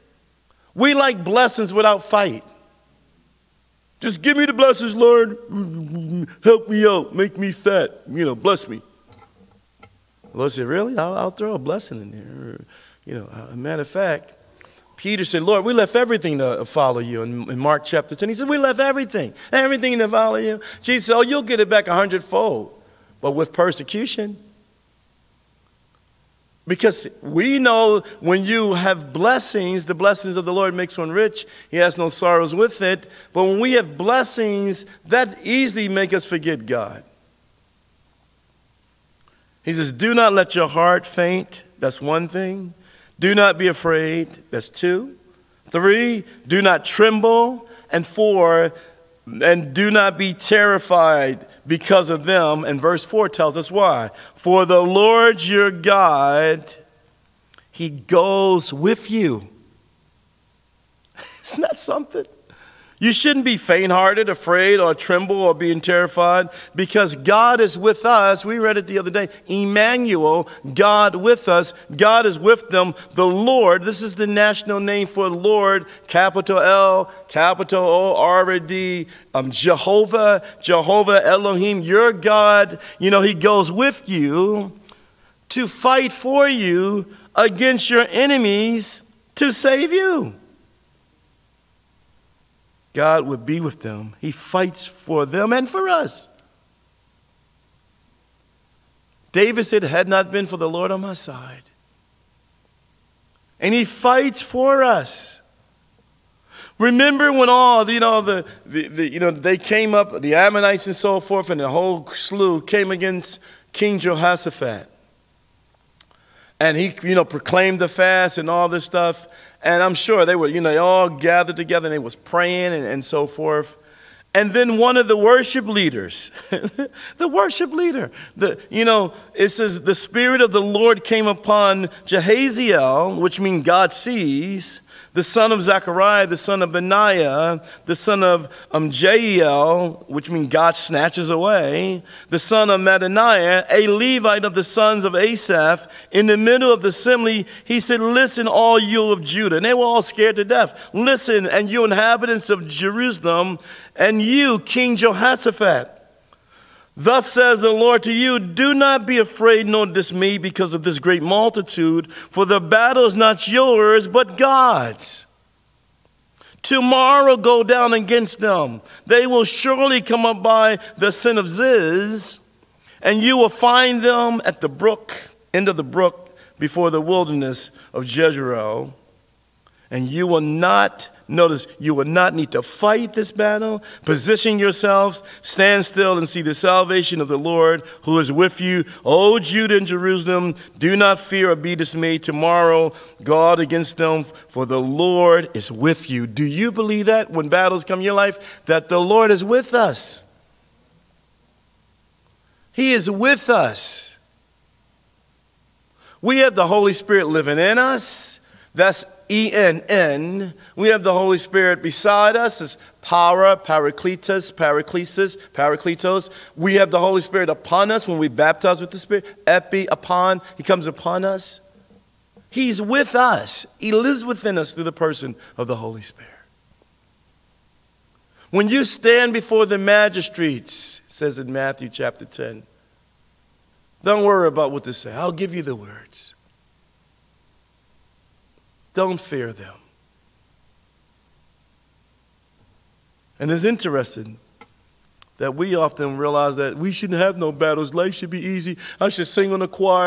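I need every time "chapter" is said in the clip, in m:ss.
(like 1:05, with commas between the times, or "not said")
0:17, 3:51.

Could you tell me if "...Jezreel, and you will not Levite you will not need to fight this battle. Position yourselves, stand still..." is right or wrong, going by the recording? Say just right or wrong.
wrong.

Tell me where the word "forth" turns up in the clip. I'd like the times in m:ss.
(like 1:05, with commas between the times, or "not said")
1:51, 2:03.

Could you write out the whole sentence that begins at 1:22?
You know, He goes with you to fight for you against your enemies to save you.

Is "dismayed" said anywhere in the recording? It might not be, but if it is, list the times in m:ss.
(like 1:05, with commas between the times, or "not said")
2:39, 3:11.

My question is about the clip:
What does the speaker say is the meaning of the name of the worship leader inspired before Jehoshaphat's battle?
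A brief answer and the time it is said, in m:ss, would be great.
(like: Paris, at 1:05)
God sees, at 2:13.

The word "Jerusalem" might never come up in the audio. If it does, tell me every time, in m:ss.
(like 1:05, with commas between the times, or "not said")
2:32, 3:09.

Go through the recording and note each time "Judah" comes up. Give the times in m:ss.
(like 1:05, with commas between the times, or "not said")
2:29, 3:09.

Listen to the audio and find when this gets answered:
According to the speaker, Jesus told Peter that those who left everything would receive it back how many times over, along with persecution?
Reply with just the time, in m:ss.
0:21.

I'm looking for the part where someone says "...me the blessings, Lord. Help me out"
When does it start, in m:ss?
0:04.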